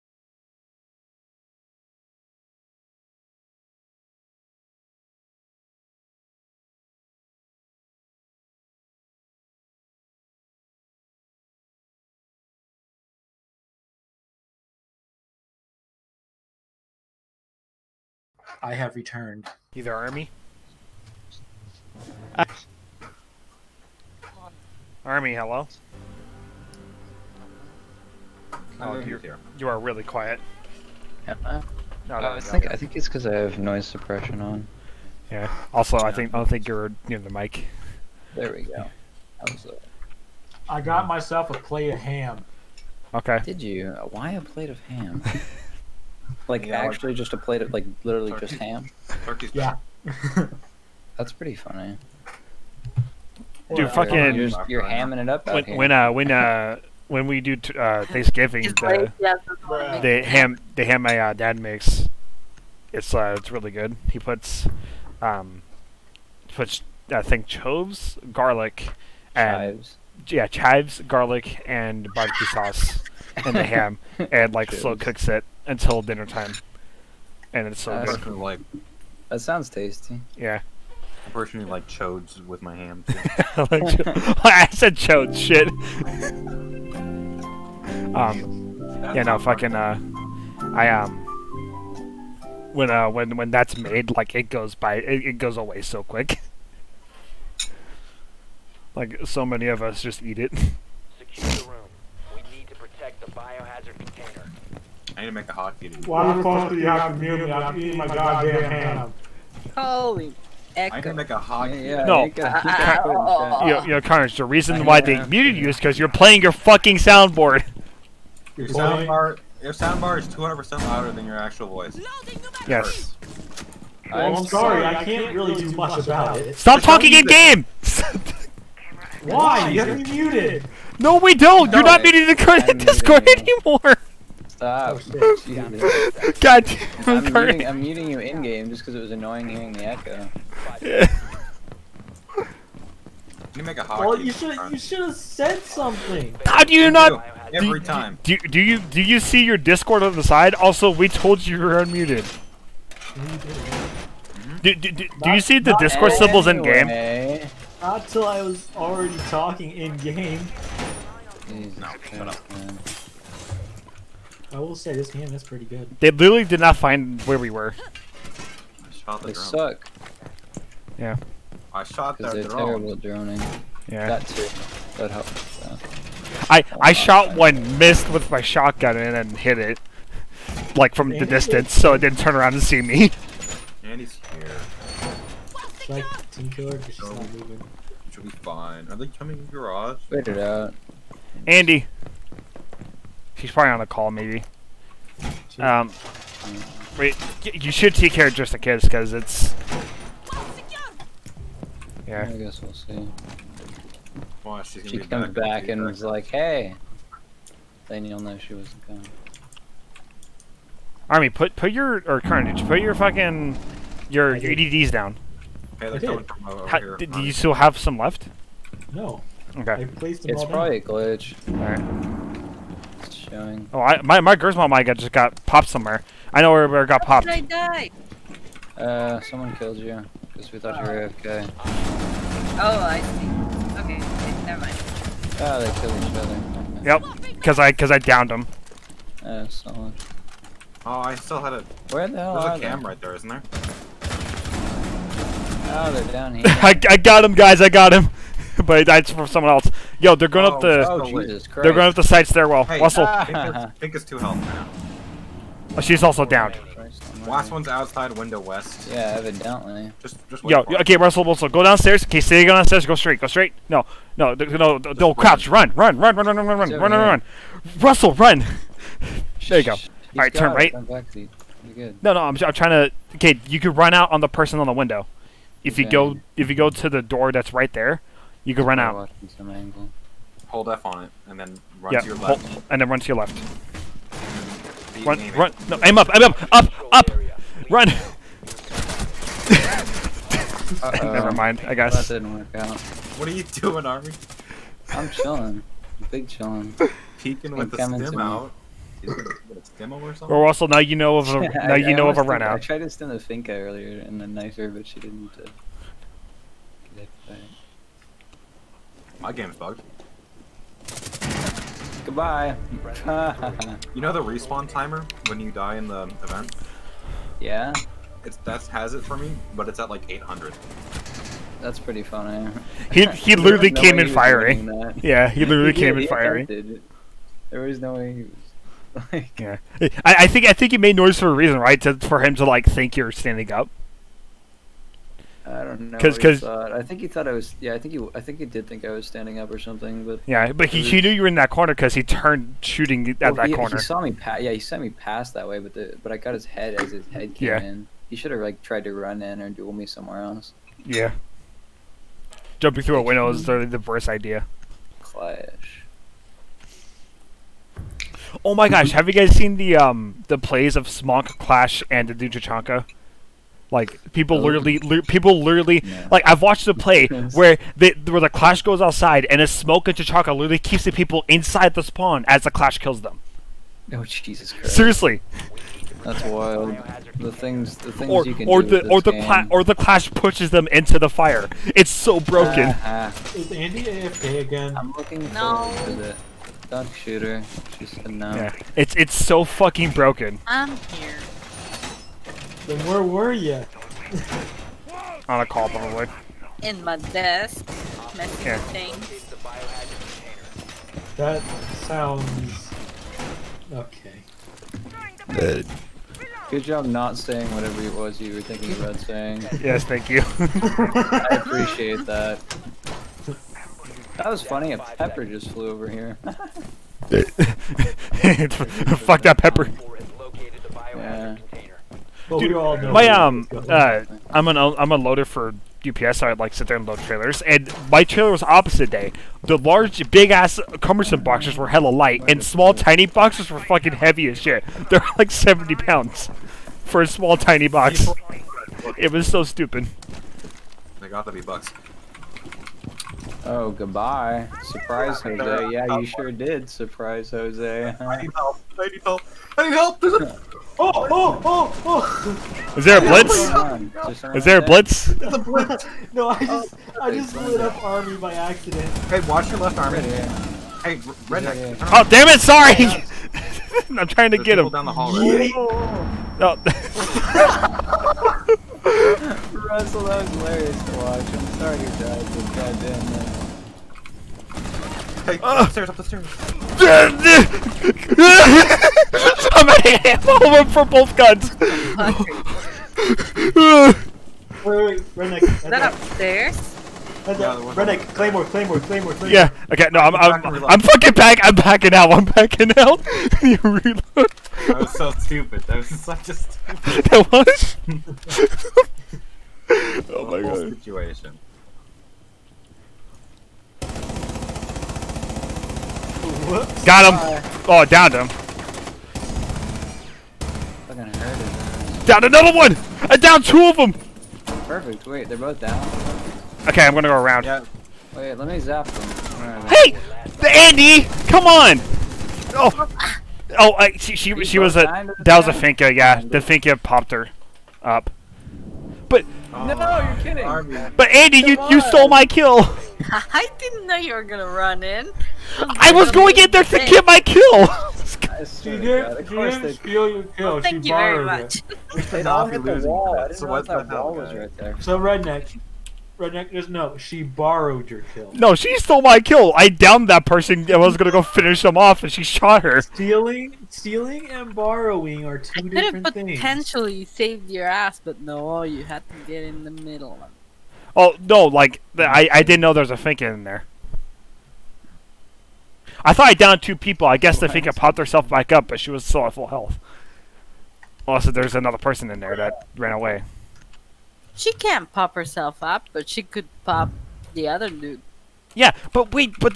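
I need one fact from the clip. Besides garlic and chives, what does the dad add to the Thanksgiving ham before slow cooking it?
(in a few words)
Barbecue sauce.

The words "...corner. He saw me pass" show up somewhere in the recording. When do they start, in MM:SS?
05:43.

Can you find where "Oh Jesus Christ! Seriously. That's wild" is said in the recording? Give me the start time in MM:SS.
06:13.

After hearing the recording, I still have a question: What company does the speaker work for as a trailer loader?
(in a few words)
UPS.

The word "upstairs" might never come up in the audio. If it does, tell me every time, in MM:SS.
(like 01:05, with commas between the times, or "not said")
07:55, 08:05.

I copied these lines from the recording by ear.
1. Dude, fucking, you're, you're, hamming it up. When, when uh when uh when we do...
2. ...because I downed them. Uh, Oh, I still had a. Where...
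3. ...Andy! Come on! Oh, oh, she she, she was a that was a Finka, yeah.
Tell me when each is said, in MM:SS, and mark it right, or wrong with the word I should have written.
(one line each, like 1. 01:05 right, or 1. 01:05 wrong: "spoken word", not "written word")
1. 00:53 right
2. 03:57 right
3. 08:40 right.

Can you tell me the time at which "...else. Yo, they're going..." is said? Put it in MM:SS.
04:09.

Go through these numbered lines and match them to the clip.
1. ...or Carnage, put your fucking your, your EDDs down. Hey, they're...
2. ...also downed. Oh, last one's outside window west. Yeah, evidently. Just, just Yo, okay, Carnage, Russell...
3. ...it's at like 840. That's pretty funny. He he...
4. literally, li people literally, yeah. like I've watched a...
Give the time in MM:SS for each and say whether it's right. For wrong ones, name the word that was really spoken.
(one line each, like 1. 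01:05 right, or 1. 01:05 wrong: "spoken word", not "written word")
1. 03:32 right
2. 04:16 wrong: "Russell", not "Carnage"
3. 05:19 wrong: "800", not "840"
4. 06:04 right.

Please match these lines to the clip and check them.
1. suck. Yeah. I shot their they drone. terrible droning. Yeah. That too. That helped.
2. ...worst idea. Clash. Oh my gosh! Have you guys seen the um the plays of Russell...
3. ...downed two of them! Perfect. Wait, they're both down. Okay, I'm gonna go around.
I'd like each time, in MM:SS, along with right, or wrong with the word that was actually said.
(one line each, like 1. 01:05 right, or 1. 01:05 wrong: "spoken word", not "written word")
1. 02:49 right
2. 05:53 wrong: "Smonk", not "Russell"
3. 08:33 right.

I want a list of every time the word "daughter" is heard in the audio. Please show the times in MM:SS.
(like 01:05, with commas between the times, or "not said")
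not said.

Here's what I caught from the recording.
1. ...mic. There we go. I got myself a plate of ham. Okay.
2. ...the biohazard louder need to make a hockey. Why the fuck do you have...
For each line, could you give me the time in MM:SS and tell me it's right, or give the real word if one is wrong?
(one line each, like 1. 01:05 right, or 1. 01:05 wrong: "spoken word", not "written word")
1. 00:37 right
2. 01:43 wrong: "container", not "louder".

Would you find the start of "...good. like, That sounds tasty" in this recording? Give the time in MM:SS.
01:18.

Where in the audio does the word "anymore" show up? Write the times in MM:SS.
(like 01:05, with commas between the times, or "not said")
02:13.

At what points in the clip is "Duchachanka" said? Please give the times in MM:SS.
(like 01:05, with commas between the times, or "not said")
06:02.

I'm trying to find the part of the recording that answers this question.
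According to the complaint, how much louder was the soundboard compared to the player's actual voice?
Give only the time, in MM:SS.
02:00.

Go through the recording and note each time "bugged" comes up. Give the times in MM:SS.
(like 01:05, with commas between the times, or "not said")
05:09.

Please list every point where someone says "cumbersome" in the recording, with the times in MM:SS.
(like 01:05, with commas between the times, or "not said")
07:10.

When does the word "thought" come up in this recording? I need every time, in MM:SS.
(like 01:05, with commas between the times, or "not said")
03:50, 05:37, 09:26.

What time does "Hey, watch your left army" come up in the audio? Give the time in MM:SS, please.
07:39.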